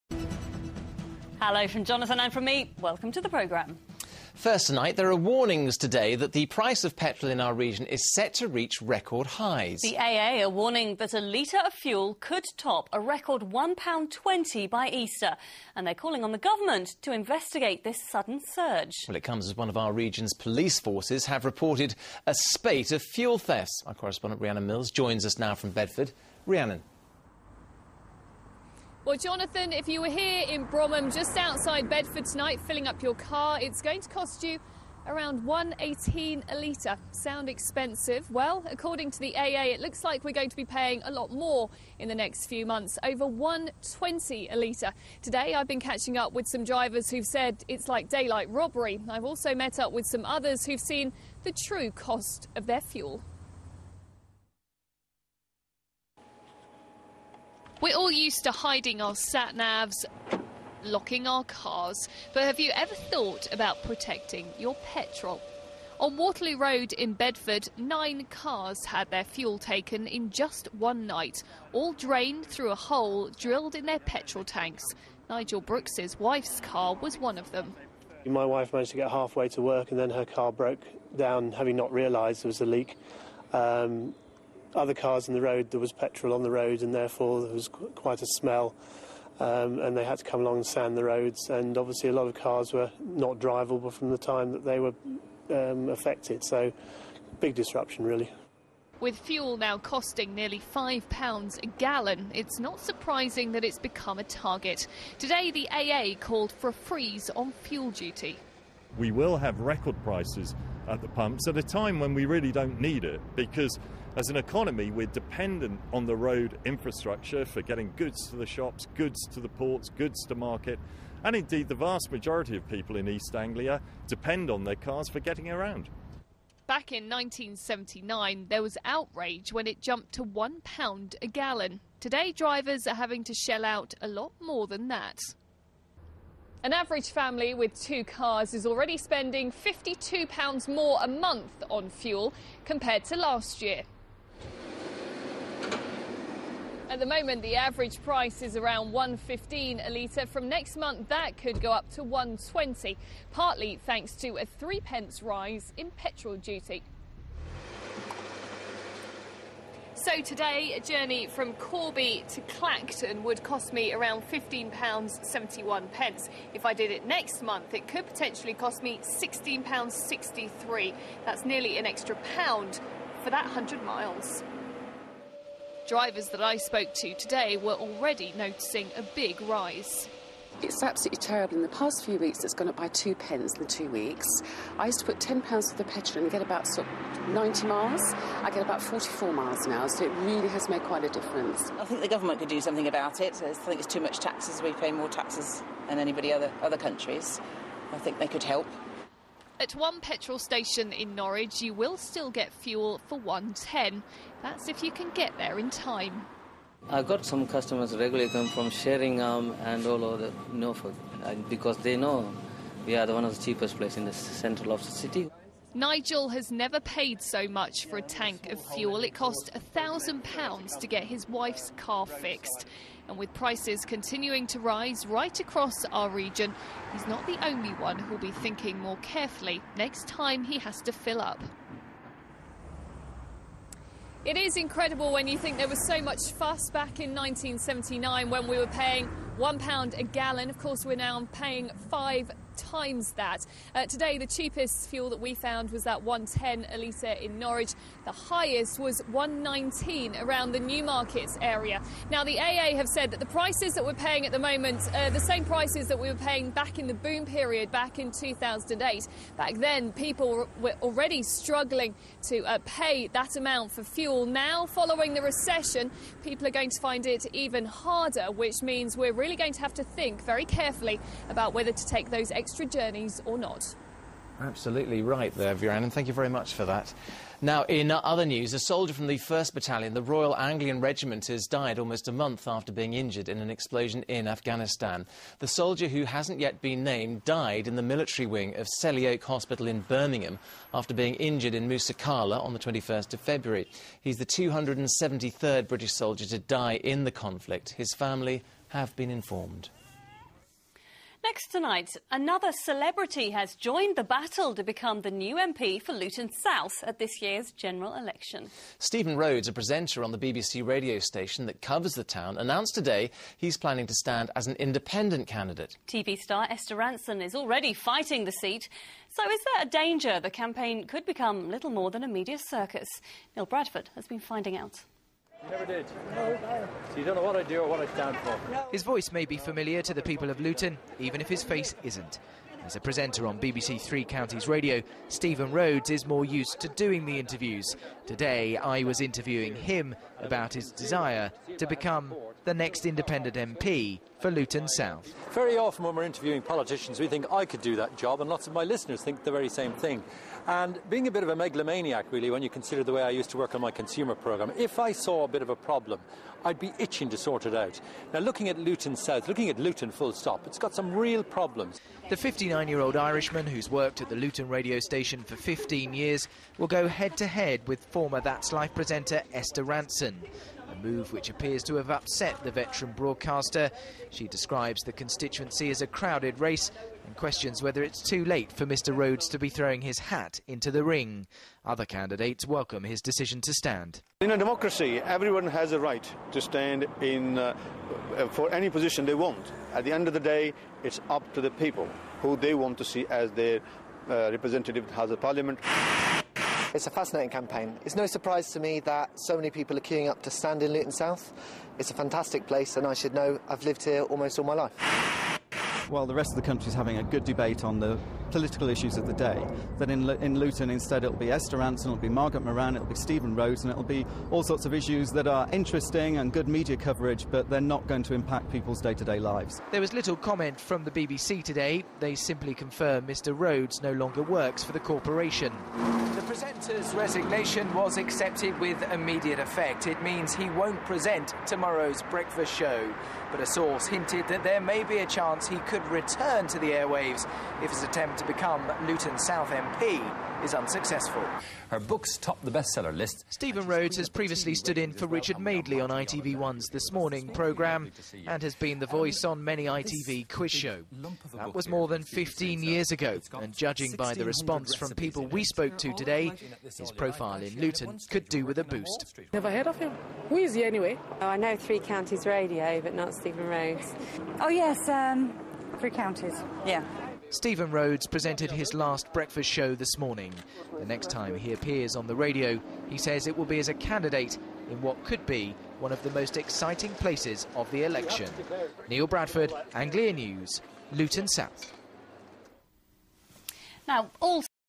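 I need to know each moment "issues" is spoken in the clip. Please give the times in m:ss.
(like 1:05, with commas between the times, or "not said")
6:48, 6:54.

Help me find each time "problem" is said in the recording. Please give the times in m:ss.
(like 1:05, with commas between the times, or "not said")
5:55, 6:01.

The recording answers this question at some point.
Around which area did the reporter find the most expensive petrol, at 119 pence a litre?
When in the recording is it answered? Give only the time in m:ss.
4:10.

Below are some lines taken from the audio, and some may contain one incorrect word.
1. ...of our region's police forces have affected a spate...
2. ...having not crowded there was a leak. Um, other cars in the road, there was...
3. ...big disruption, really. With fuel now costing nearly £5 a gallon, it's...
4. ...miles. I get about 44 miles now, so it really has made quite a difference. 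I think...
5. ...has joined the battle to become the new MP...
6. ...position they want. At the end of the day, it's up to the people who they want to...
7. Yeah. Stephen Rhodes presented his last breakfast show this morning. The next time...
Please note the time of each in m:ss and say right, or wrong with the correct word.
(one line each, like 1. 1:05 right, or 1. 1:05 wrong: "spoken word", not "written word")
1. 0:19 wrong: "reported", not "affected"
2. 1:21 wrong: "realised", not "crowded"
3. 1:37 right
4. 3:07 right
5. 5:03 right
6. 6:28 right
7. 7:46 right.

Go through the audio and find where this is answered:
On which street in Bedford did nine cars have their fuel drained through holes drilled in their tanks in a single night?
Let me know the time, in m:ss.
1:06.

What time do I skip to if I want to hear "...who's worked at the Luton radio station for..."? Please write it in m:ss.
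6:03.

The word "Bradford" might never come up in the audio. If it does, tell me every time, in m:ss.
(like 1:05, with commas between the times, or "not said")
5:23, 7:59.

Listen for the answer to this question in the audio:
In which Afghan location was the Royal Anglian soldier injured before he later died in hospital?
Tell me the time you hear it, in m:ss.
4:51.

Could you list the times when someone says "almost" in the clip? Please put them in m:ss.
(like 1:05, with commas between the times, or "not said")
4:41, 6:44.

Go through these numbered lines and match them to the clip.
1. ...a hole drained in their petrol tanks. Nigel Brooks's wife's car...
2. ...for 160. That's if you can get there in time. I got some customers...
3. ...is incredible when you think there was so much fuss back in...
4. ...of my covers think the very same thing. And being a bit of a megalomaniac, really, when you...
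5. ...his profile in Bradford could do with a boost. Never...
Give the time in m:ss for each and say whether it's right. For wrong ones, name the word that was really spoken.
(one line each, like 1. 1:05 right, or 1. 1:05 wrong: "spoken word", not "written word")
1. 1:12 wrong: "drilled", not "drained"
2. 3:23 wrong: "110", not "160"
3. 3:54 right
4. 5:48 wrong: "listeners", not "covers"
5. 7:36 wrong: "Luton", not "Bradford".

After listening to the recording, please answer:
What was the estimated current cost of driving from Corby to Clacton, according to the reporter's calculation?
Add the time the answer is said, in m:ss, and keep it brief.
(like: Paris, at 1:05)
£15.71, at 2:44.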